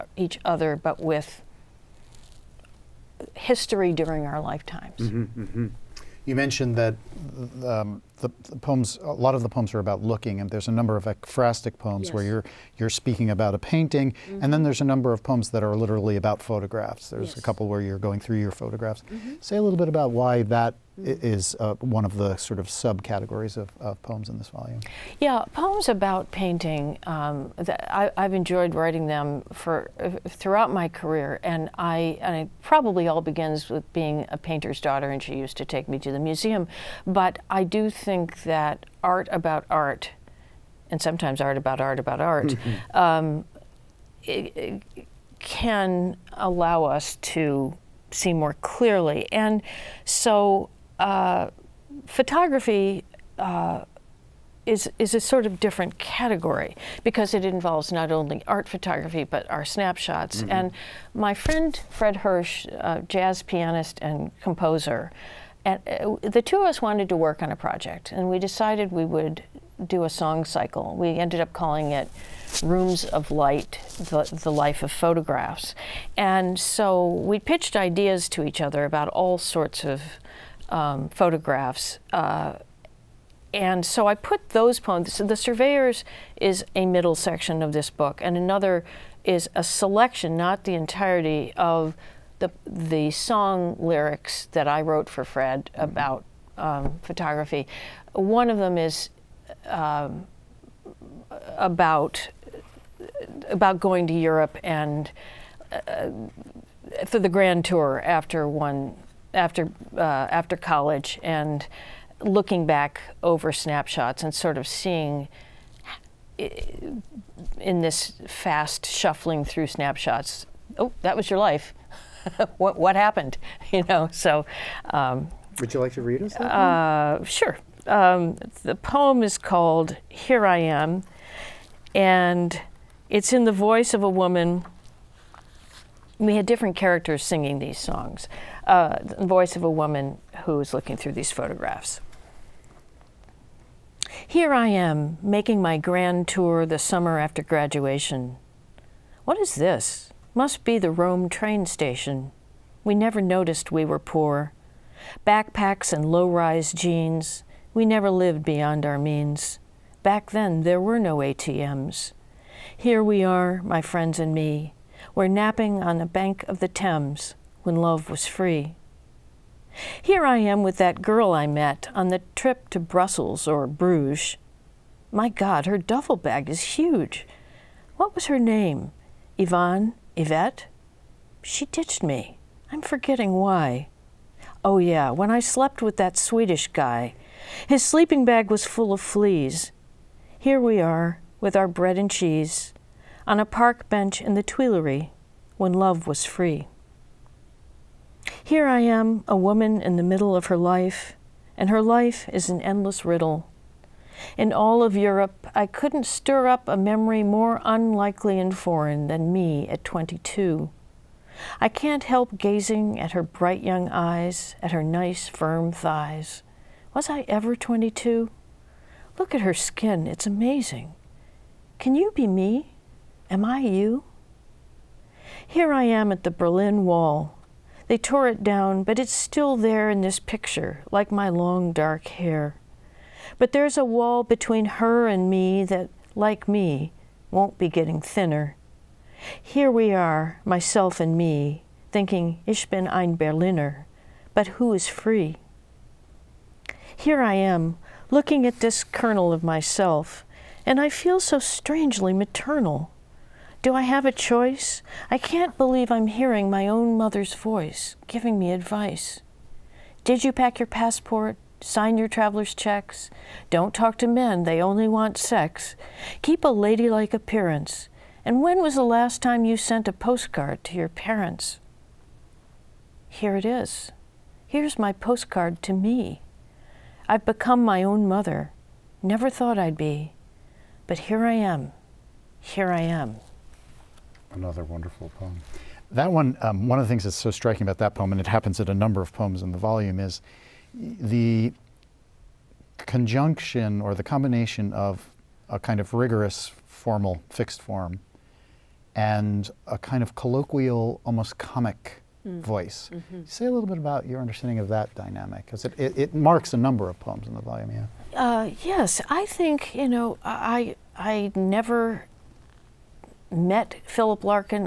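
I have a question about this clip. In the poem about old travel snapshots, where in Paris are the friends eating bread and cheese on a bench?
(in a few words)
the Tuileries.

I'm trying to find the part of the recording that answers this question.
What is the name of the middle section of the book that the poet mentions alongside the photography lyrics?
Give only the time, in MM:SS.
01:25.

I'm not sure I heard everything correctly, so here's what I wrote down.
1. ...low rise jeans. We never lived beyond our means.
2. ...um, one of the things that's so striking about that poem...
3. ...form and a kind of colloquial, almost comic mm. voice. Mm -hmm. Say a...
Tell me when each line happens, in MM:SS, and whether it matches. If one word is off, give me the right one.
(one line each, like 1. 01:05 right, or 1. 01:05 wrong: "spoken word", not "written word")
1. 02:36 right
2. 04:46 right
3. 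04:57 right.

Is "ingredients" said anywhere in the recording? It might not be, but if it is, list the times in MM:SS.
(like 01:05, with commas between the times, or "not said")
not said.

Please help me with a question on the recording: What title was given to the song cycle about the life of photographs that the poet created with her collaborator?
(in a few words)
Rooms of Light.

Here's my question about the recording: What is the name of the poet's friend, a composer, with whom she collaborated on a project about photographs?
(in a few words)
Fred Hersch.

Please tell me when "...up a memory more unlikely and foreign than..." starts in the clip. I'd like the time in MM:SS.
03:26.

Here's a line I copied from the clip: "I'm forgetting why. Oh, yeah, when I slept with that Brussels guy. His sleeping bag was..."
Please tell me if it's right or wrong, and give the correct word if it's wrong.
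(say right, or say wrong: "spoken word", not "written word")
wrong: "Swedish", not "Brussels".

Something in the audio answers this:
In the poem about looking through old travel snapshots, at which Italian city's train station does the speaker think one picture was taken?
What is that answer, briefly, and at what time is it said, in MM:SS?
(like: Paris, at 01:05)
Rome, at 02:30.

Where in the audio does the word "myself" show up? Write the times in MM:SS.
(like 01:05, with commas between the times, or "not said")
04:00, 04:09.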